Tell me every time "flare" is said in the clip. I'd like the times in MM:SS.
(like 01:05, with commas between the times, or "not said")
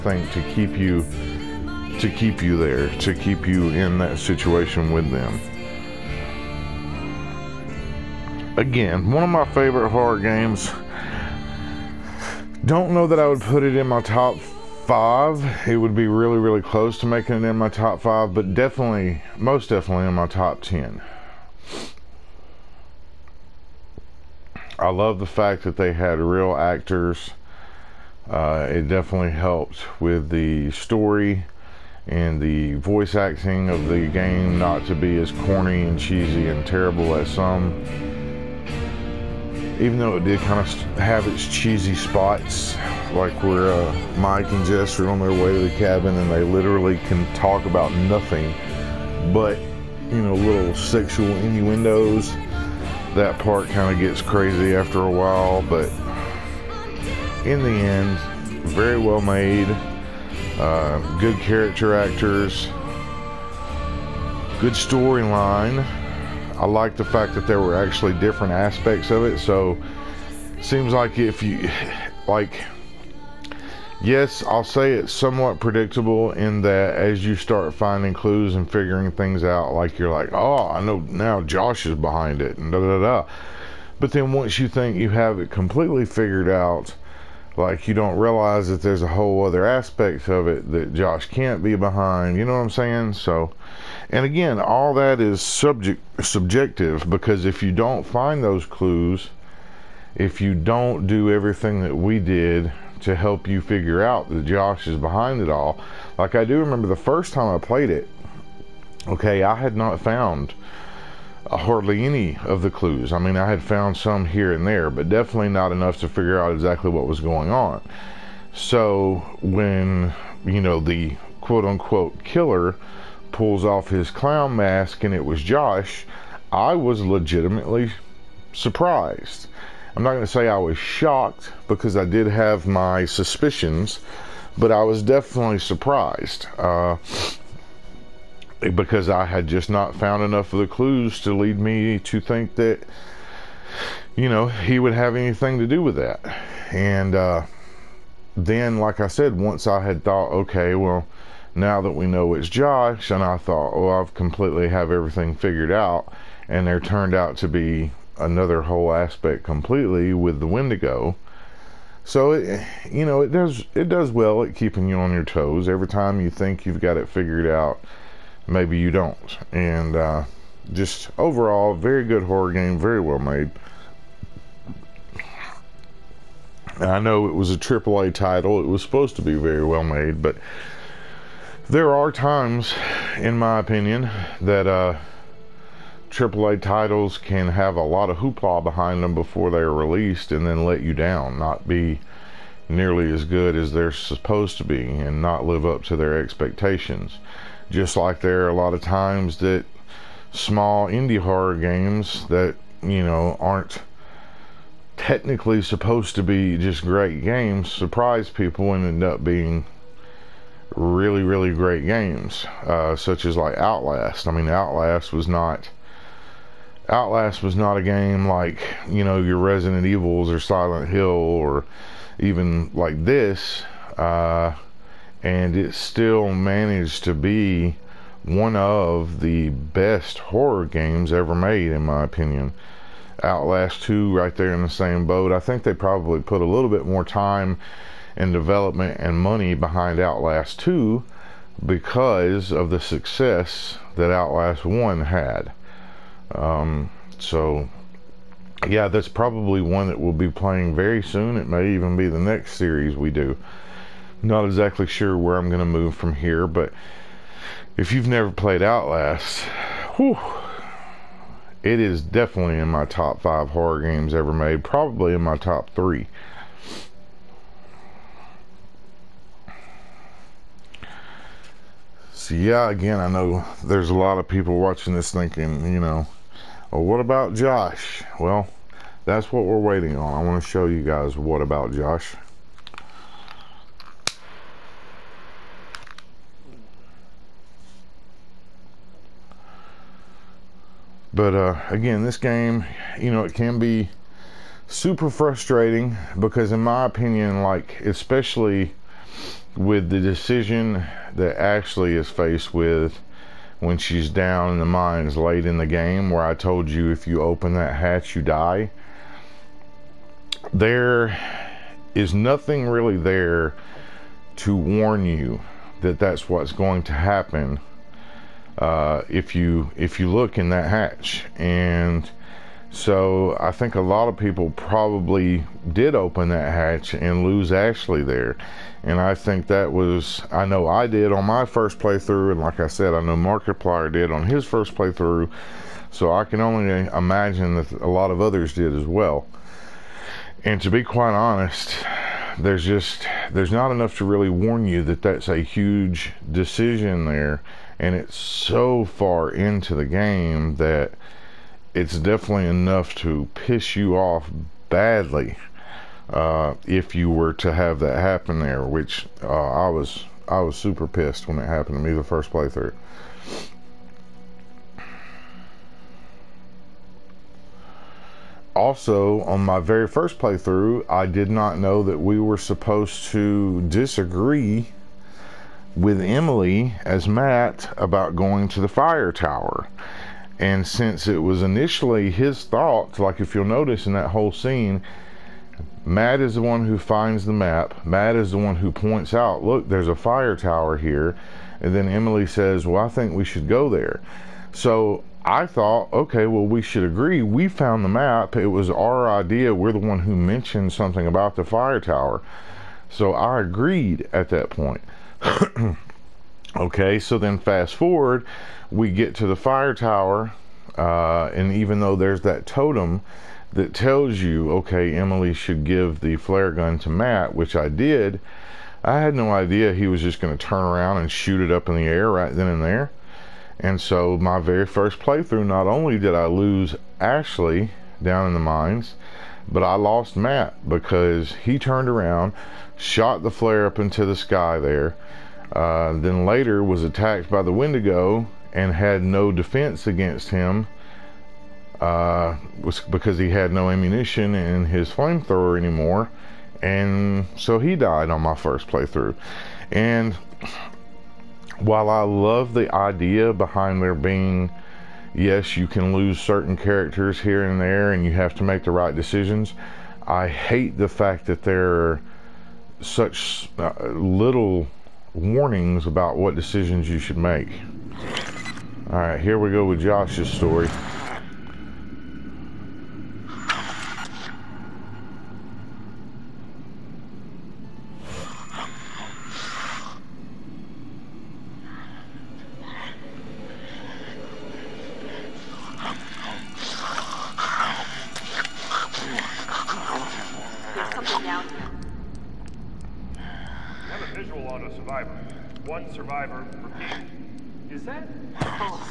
06:56, 07:13.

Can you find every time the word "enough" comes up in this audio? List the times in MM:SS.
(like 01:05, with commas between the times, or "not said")
01:55, 02:20, 05:43, 05:52.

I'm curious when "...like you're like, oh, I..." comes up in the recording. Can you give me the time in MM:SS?
01:19.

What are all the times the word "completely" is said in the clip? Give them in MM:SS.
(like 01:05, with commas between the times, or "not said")
01:25, 02:34, 02:39.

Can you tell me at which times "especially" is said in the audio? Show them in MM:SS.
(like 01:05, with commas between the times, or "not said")
04:57.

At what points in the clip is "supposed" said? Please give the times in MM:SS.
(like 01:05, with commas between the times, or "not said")
02:58, 03:13, 03:25, 06:12.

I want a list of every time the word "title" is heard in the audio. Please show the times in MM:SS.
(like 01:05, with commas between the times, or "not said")
02:58, 03:06.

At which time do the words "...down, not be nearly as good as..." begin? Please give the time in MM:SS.
03:10.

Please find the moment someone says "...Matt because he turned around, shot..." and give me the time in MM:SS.
07:10.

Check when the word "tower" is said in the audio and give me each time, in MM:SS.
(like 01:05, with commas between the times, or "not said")
06:19, 06:30, 06:41, 06:49.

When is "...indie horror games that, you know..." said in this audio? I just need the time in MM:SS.
03:20.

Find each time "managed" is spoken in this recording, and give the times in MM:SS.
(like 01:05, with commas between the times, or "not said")
03:46.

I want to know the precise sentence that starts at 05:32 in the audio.
And like I said, I know Markiplier did on his first playthrough.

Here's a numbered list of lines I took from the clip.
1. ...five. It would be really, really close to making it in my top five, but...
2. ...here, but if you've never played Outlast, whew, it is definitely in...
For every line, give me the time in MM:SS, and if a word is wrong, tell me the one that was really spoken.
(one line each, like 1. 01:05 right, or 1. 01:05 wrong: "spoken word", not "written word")
1. 00:14 right
2. 04:16 right.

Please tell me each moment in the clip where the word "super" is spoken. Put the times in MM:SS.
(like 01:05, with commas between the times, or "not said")
04:54, 06:00.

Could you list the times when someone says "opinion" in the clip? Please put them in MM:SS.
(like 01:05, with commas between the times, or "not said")
03:03, 03:52, 04:56.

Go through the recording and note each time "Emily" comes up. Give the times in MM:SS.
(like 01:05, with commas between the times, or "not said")
06:16, 06:31, 06:54.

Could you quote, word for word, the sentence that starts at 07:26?
And so he died on my first playthrough.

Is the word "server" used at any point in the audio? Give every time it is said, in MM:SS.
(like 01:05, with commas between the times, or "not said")
not said.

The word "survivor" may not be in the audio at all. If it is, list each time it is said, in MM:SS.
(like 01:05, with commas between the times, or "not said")
08:15.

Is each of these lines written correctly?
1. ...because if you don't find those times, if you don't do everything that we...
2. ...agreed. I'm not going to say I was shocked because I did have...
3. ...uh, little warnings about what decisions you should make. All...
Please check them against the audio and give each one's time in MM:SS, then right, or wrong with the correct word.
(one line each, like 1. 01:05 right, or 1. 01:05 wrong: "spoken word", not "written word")
1. 01:37 wrong: "clues", not "times"
2. 02:08 wrong: "surprised", not "agreed"
3. 07:43 right.